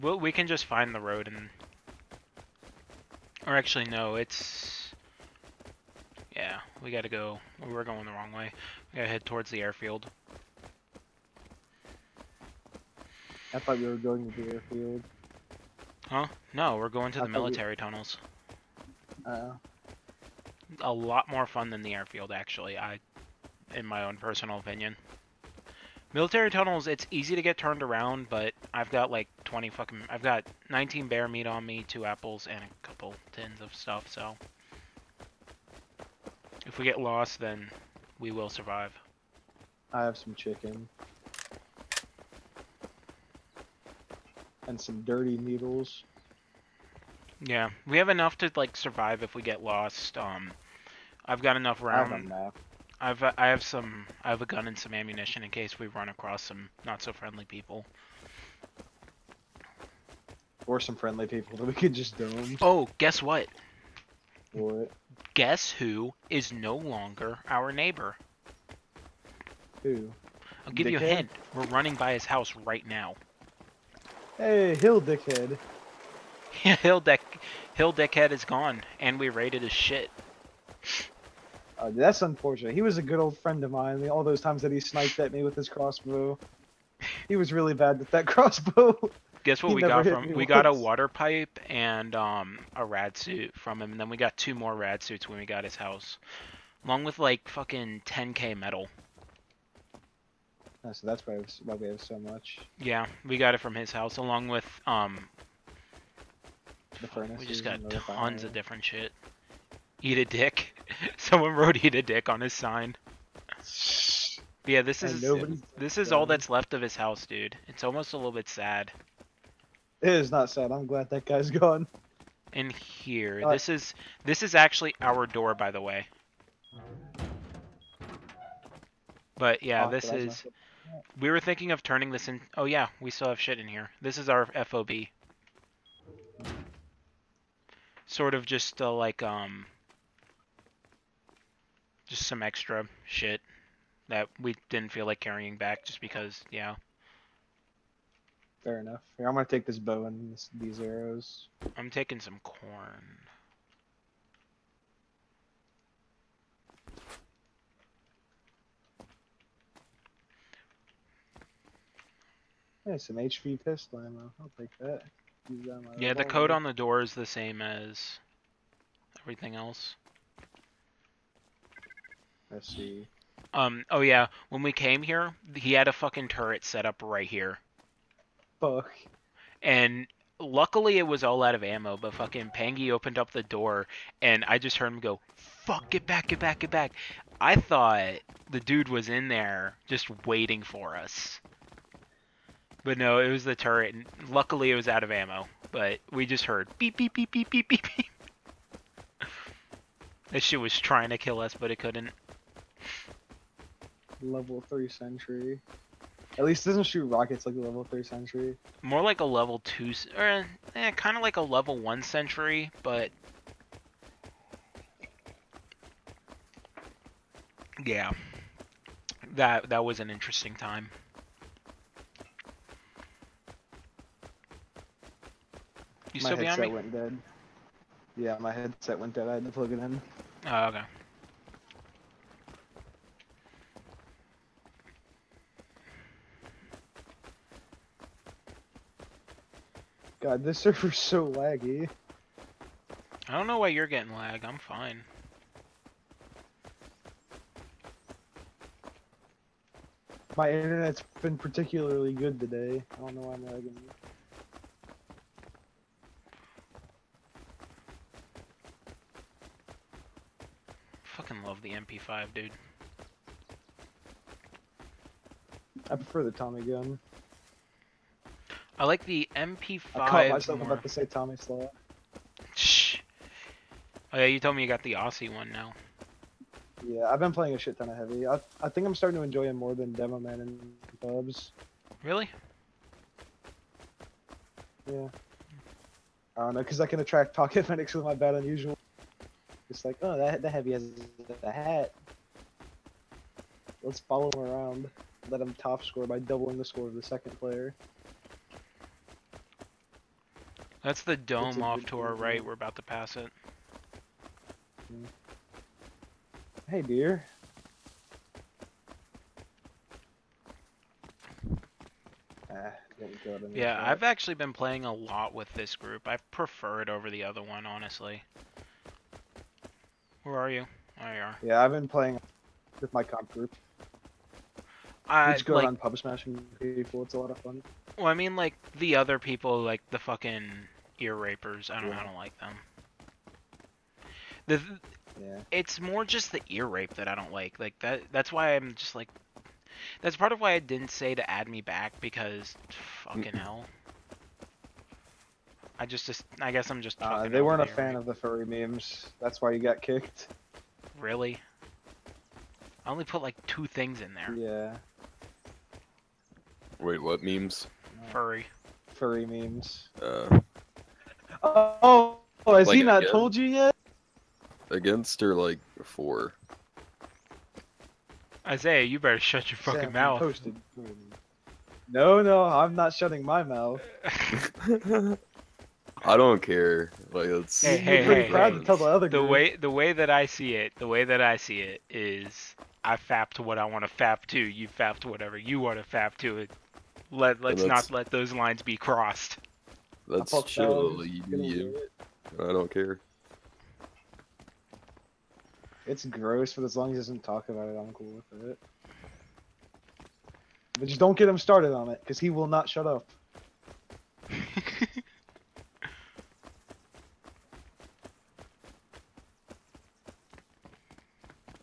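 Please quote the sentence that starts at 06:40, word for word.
But just don't get him started on it, because he will not shut up.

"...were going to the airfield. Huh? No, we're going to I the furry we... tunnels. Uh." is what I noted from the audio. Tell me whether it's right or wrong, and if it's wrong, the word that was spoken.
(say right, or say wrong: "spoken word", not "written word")
wrong: "military", not "furry".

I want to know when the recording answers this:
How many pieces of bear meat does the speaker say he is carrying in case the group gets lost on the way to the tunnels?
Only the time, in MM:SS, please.
00:30.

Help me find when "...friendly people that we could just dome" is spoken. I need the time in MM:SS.
01:00.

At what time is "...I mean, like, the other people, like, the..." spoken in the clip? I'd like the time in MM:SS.
05:28.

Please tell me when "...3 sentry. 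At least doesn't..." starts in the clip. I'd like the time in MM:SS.
03:24.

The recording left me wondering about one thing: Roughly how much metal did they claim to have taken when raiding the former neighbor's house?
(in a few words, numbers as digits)
10k.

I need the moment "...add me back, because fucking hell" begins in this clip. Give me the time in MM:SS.
05:41.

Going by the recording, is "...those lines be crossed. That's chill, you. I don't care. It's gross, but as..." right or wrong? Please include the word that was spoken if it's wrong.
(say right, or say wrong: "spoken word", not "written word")
right.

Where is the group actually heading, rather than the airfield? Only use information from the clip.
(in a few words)
military tunnels.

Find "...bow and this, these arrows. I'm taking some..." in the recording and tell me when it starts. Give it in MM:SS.
02:29.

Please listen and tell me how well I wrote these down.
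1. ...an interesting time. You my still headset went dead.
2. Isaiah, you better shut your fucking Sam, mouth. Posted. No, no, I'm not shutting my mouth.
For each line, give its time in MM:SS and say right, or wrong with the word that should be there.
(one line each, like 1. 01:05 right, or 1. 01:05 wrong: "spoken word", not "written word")
1. 03:39 right
2. 06:08 right.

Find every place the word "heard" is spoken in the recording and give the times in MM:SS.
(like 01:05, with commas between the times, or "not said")
03:04, 03:16.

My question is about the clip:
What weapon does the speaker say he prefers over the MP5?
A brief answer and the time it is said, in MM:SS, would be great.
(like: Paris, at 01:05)
Tommy gun, at 04:26.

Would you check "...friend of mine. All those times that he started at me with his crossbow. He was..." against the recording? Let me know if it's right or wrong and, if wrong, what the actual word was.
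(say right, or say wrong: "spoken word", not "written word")
wrong: "sniped", not "started".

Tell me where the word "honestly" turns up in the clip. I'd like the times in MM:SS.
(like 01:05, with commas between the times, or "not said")
05:17.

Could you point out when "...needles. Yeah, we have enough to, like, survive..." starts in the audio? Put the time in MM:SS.
00:45.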